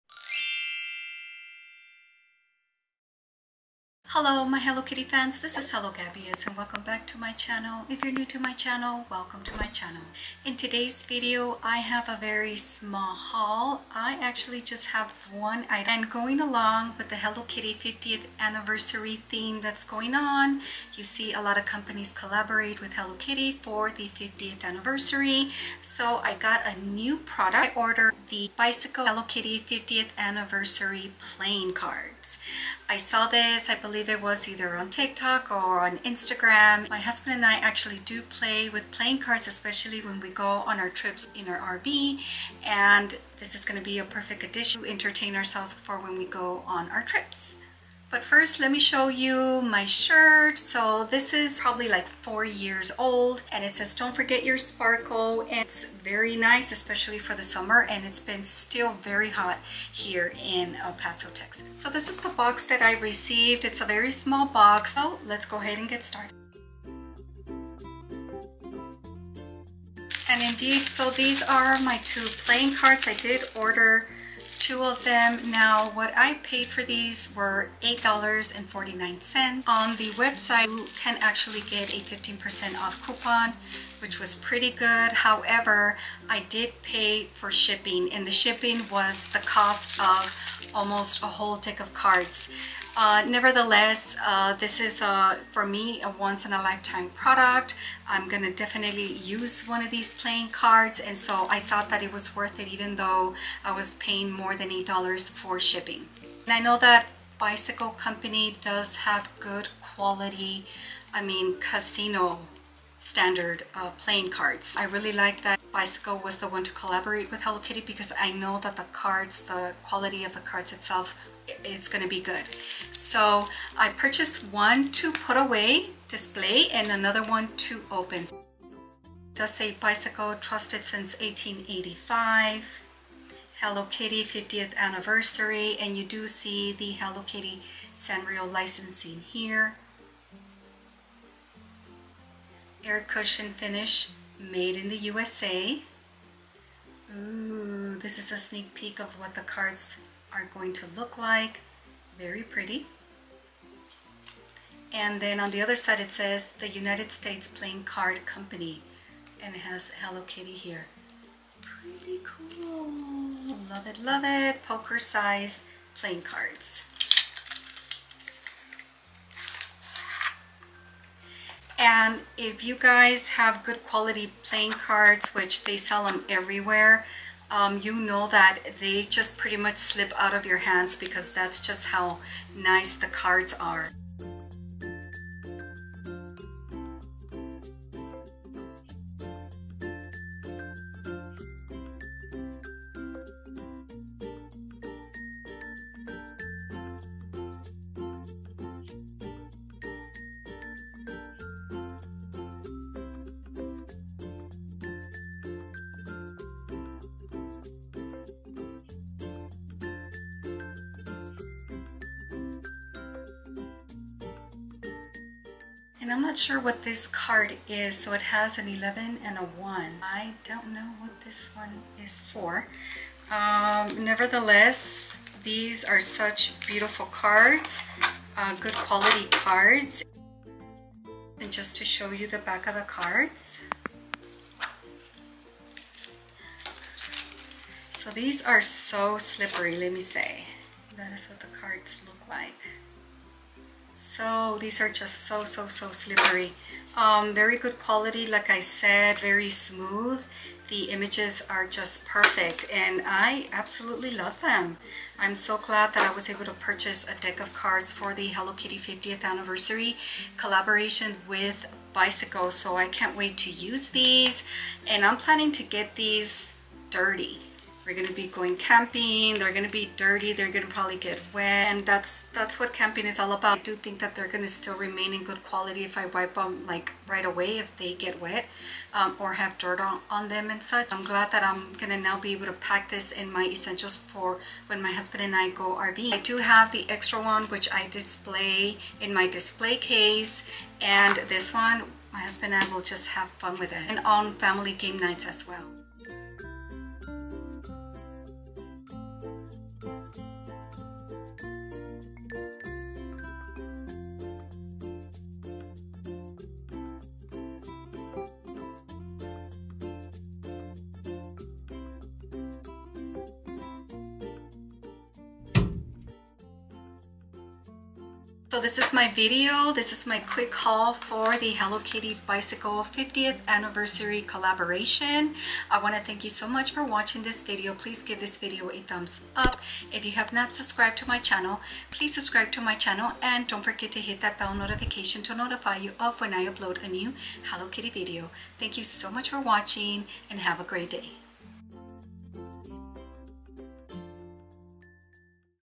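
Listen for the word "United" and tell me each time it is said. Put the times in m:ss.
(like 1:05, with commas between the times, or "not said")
2:36.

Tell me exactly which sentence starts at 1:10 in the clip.
And indeed, so these are my two playing cards.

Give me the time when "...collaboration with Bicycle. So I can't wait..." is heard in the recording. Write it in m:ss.
4:20.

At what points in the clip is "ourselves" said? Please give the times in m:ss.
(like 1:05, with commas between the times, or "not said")
0:45.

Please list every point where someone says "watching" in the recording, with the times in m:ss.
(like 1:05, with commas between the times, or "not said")
5:26, 5:39.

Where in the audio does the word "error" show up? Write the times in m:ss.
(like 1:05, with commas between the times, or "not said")
not said.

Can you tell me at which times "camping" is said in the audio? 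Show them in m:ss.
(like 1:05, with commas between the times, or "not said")
4:28, 4:32.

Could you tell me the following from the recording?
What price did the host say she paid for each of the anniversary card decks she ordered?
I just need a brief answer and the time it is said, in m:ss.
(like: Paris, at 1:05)
$8.49, at 1:17.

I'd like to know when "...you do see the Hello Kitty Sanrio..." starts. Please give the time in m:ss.
2:15.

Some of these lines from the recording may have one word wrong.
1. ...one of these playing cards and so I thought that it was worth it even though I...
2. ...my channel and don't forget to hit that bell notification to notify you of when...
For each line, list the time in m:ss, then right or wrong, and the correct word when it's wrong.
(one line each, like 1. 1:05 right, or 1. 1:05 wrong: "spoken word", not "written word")
1. 1:39 right
2. 5:32 right.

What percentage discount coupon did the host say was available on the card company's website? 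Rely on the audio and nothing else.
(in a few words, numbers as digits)
15%.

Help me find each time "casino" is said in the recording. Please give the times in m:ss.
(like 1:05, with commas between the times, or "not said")
1:51.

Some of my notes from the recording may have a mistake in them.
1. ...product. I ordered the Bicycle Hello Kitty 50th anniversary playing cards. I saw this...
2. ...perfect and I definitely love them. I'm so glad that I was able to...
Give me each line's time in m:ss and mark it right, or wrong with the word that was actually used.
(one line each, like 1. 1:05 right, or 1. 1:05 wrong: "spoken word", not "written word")
1. 0:27 right
2. 4:12 wrong: "absolutely", not "definitely".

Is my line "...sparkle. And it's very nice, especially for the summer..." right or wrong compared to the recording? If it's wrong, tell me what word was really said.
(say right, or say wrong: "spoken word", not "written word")
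right.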